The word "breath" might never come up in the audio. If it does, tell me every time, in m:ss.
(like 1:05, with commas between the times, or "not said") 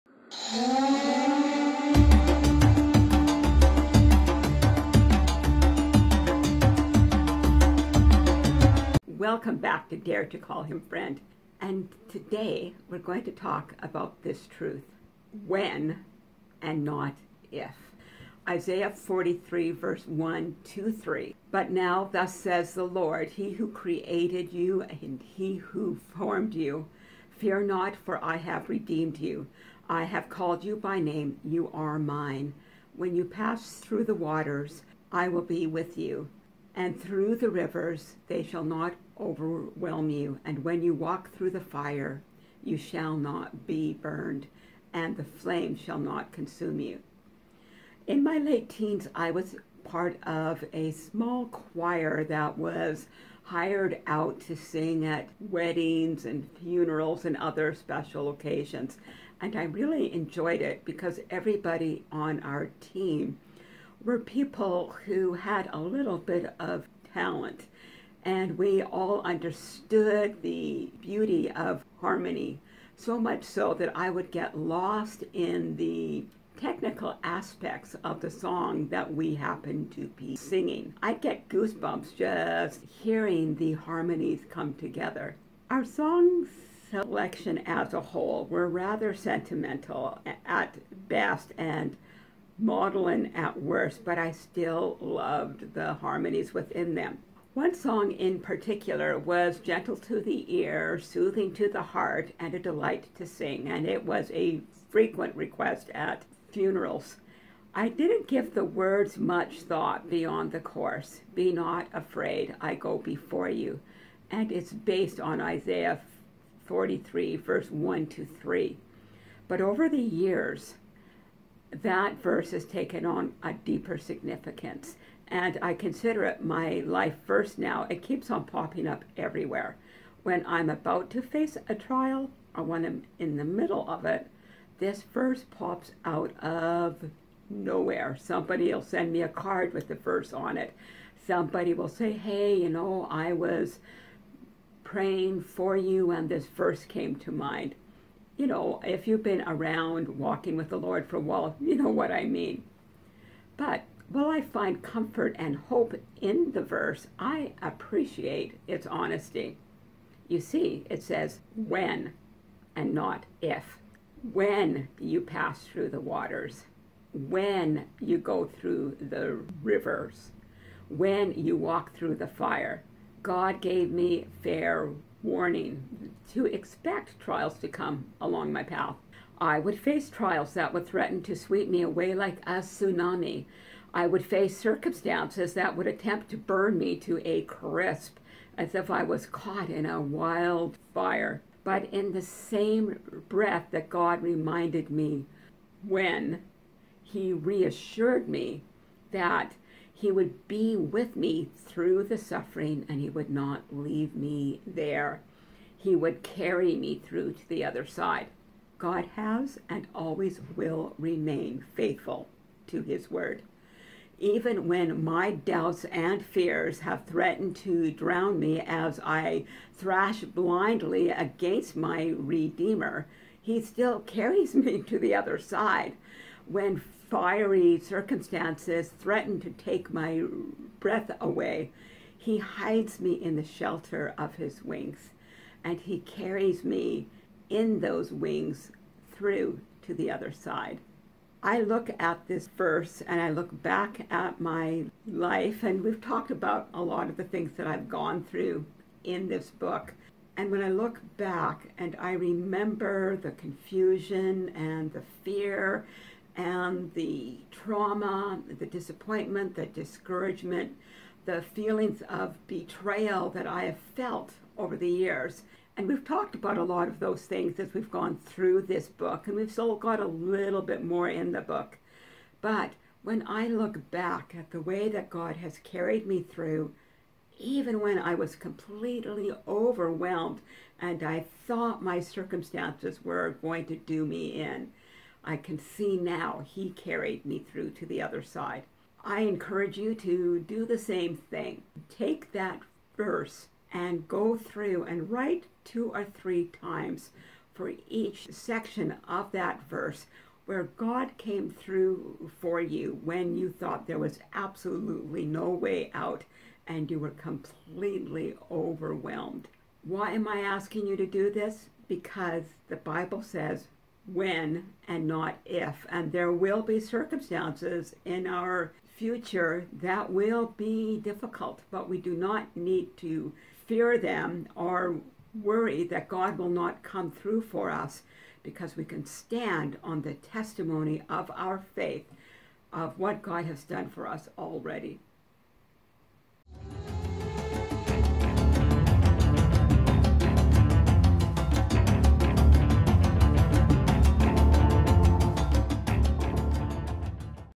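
3:13, 3:50.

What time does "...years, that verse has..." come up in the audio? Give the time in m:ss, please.
1:59.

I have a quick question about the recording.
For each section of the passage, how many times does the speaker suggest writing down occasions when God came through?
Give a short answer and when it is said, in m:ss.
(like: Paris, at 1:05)
2 or 3, at 4:55.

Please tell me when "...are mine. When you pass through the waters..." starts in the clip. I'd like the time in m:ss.
0:31.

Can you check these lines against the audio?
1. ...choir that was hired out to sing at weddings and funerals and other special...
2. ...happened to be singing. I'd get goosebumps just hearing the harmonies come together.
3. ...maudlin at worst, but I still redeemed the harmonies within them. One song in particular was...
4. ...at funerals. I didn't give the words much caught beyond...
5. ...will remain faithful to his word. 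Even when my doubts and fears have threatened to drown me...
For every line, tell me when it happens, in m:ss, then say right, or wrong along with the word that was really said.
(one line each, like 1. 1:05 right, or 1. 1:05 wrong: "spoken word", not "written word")
1. 0:51 right
2. 1:19 right
3. 1:32 wrong: "loved", not "redeemed"
4. 1:45 wrong: "thought", not "caught"
5. 3:30 right.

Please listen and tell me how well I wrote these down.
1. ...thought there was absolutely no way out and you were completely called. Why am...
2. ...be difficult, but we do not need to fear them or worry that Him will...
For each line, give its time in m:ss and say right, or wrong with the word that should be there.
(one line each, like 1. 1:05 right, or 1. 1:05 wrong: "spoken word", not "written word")
1. 5:03 wrong: "overwhelmed", not "called"
2. 5:20 wrong: "God", not "Him".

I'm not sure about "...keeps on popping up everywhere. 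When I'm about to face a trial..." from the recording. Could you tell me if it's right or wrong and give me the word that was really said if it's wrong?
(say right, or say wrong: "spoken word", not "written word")
right.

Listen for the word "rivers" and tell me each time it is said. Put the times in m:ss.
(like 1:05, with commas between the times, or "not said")
0:37, 2:49.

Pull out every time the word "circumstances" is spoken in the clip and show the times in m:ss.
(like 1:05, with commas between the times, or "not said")
3:04, 3:47, 4:41, 5:16.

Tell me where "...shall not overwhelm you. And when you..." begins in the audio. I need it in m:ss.
0:38.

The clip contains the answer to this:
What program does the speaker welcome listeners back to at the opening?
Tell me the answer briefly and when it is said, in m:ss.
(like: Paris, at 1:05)
Dare to Call Him Friend, at 0:09.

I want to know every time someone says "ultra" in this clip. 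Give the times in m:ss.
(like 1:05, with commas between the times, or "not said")
not said.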